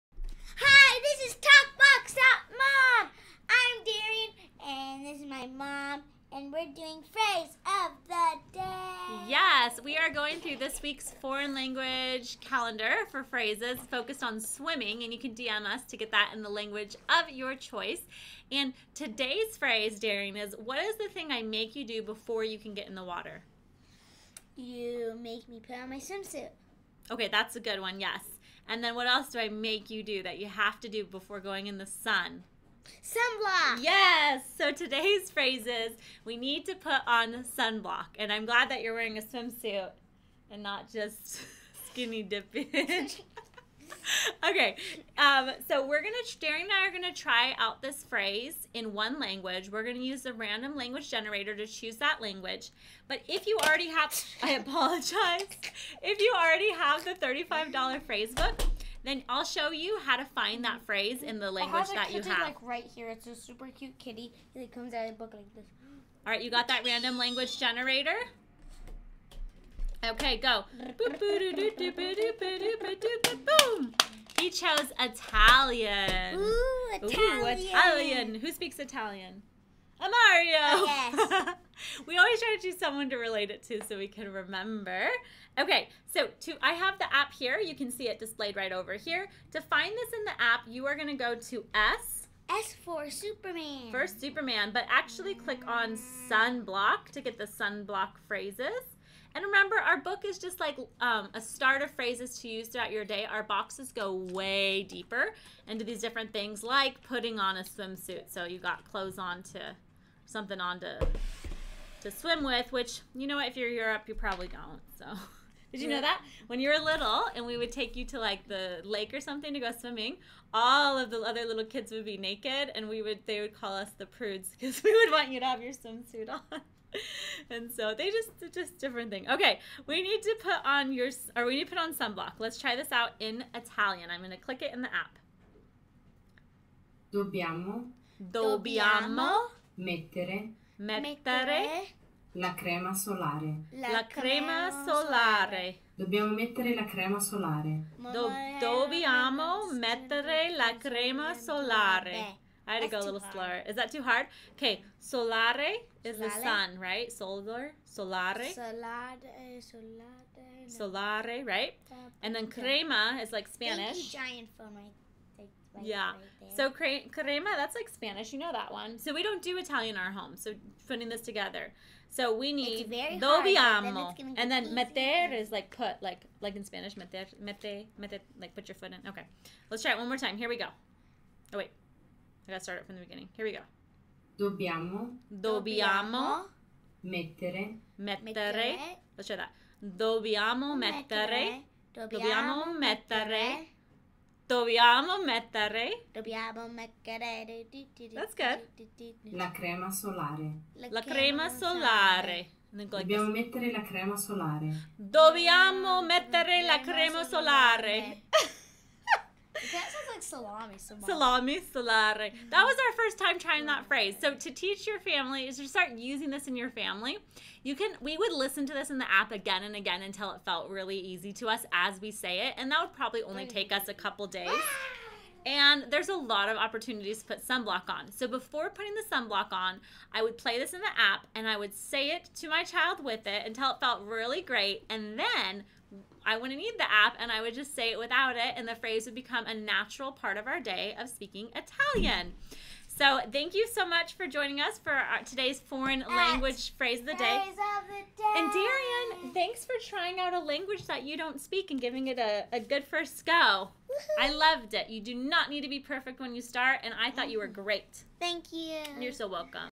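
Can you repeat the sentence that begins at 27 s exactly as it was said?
Okay, that's a good one, yes.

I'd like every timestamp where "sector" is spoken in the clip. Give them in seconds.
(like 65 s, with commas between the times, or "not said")
not said.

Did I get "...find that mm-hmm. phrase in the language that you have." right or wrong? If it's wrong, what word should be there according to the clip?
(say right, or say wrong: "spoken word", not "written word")
right.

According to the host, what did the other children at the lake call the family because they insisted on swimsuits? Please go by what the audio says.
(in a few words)
the prudes.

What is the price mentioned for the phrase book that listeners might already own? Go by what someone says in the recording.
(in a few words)
$35.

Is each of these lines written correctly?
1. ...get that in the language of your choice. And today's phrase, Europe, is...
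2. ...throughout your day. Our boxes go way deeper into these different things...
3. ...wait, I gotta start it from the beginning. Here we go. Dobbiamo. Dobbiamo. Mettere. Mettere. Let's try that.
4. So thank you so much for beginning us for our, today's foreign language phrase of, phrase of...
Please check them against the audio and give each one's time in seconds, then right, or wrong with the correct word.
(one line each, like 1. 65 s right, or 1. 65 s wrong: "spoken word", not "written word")
1. 15 s wrong: "Daring", not "Europe"
2. 102 s right
3. 181 s right
4. 242 s wrong: "joining", not "beginning".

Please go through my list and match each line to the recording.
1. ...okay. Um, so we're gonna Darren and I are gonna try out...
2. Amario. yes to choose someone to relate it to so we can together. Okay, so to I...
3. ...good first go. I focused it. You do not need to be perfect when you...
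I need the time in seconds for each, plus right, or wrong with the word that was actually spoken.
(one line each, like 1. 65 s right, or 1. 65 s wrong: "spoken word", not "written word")
1. 44 s right
2. 80 s wrong: "remember", not "together"
3. 252 s wrong: "loved", not "focused".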